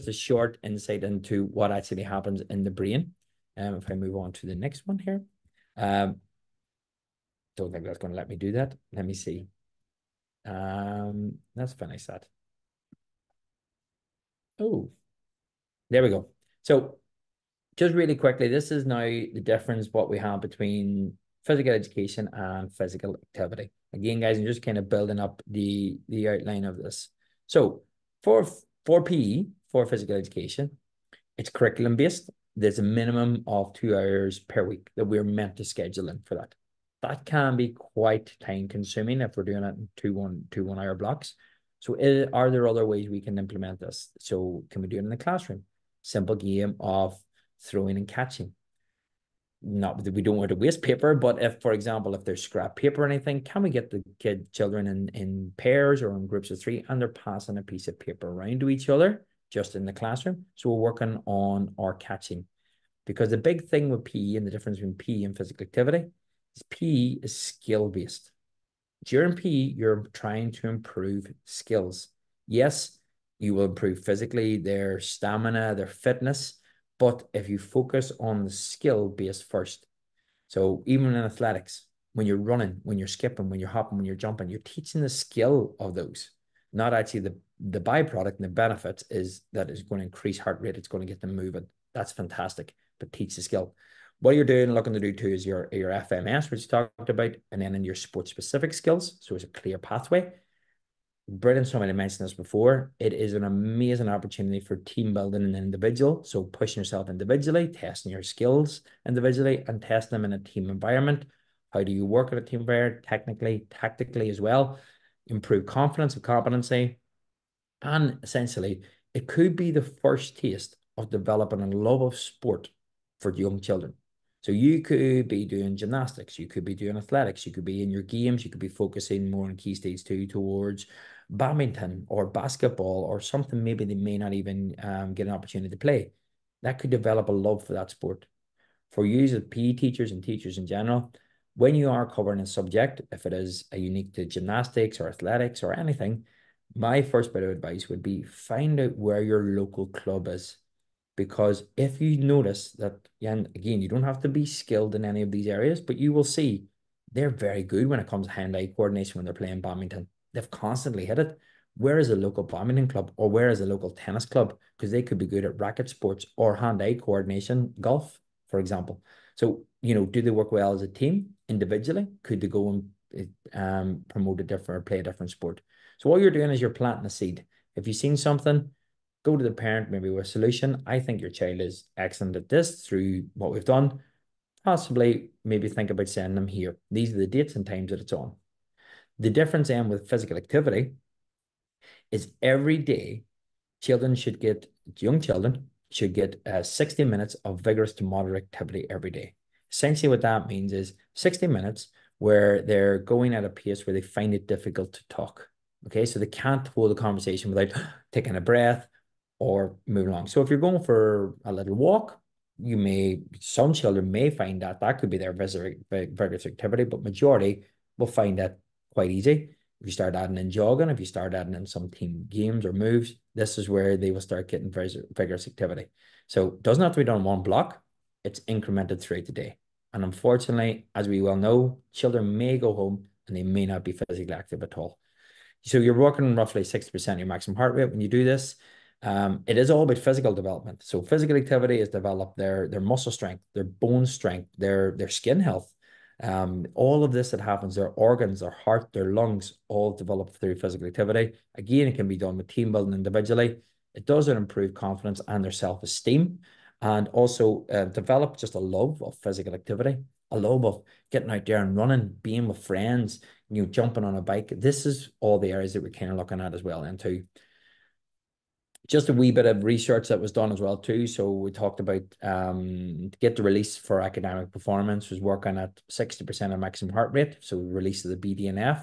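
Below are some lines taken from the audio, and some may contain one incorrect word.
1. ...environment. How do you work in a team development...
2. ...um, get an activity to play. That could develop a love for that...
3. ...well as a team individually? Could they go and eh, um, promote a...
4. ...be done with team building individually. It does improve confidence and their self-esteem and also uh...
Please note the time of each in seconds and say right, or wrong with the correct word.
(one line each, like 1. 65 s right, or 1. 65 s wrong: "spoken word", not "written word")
1. 110 s wrong: "environment", not "development"
2. 134 s wrong: "opportunity", not "activity"
3. 170 s right
4. 252 s right.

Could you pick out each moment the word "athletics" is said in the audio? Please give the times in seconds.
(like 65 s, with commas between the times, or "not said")
81 s, 126 s, 145 s.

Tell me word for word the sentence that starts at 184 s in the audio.
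Possibly maybe think about sending them here.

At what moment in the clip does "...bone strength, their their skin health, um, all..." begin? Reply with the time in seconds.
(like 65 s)
243 s.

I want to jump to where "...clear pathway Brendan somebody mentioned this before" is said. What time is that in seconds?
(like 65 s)
99 s.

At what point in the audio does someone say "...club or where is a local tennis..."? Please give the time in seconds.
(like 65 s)
162 s.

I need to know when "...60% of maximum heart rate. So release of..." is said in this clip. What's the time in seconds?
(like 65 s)
275 s.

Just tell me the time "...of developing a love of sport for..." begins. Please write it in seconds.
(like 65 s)
120 s.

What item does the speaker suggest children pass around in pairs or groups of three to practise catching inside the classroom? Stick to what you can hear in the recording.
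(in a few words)
Scrap paper.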